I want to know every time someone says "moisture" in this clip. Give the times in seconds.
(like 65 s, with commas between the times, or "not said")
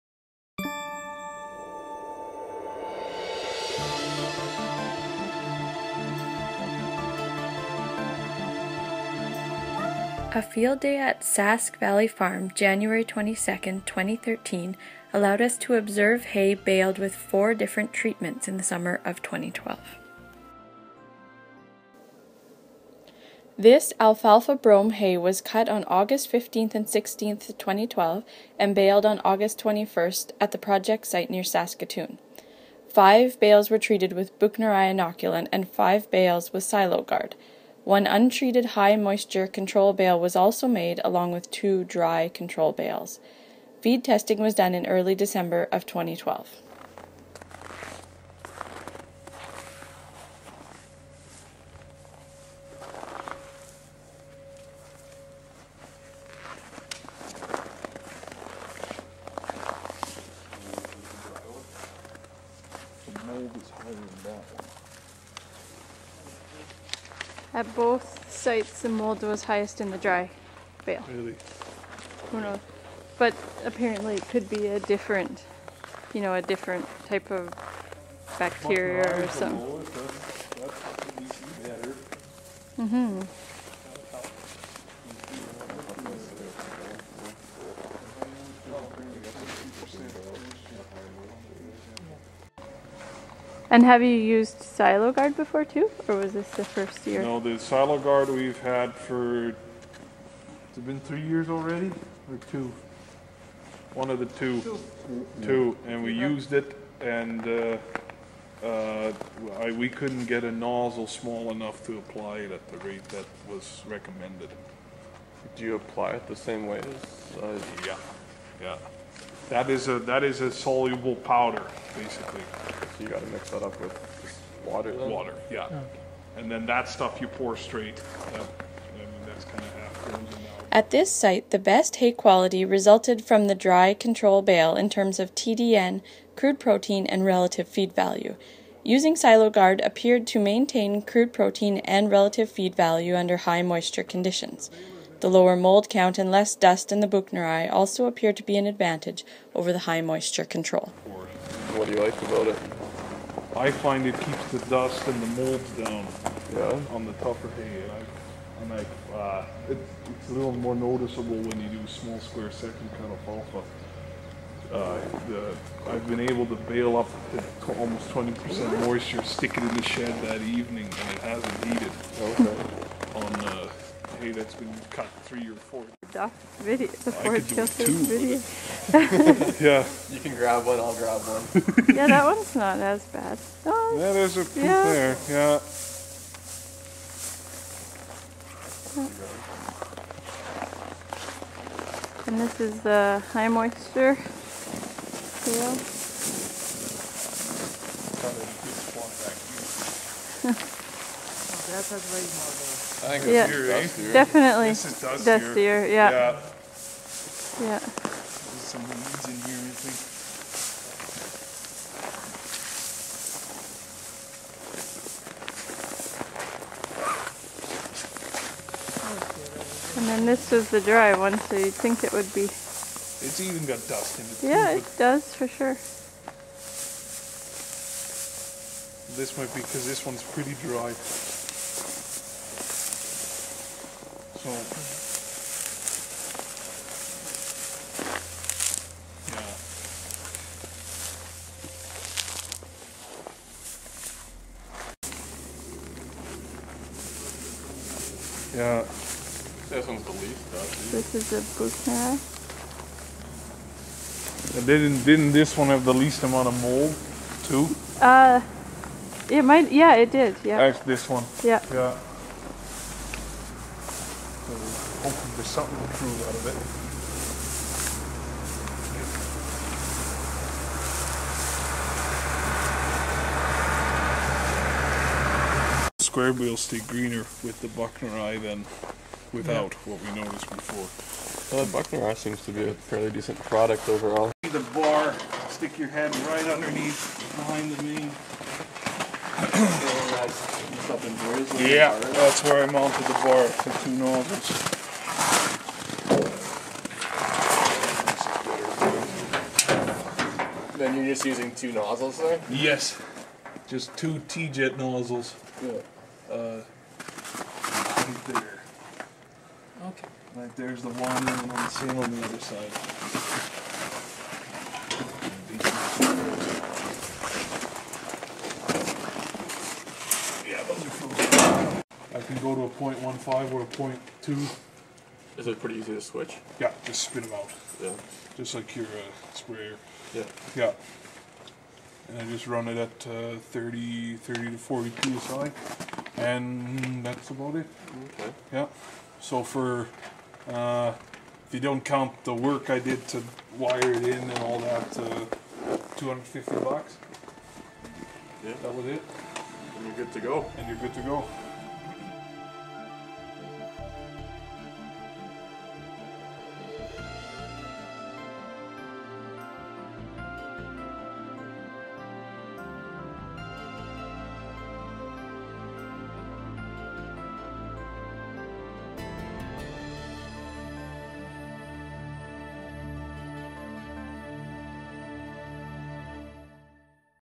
38 s, 143 s, 150 s, 168 s, 193 s.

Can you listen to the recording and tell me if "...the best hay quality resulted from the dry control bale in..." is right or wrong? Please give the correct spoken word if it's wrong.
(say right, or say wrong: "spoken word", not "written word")
right.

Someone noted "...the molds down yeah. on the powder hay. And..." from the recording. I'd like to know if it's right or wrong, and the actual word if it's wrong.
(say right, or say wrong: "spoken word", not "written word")
wrong: "tougher", not "powder".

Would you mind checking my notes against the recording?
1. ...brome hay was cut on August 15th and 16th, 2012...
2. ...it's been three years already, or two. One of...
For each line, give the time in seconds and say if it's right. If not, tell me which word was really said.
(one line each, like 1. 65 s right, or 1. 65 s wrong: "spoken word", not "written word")
1. 24 s right
2. 99 s right.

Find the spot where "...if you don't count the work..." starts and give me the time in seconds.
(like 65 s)
341 s.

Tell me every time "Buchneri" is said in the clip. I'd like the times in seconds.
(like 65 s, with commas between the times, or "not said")
34 s, 147 s, 281 s.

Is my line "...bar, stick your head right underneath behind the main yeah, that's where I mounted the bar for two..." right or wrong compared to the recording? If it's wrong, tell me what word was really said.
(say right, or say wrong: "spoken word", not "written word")
right.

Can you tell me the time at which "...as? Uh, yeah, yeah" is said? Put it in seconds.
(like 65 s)
116 s.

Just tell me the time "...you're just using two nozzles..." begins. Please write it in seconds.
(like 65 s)
300 s.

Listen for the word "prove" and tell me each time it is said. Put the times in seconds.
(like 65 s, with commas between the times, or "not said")
265 s.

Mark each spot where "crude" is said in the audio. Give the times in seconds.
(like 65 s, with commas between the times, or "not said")
136 s, 141 s.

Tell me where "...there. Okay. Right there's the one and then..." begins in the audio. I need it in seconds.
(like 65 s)
308 s.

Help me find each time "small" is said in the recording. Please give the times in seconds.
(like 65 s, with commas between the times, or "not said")
111 s, 161 s.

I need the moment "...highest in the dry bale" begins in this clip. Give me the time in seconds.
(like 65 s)
69 s.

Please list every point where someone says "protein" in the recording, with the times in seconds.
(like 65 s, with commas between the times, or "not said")
136 s, 141 s.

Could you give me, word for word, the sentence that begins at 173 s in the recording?
on uh, hay, that's been cut three or four.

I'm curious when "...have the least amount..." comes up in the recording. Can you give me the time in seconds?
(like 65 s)
255 s.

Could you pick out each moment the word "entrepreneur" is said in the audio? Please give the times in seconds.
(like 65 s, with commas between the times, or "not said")
not said.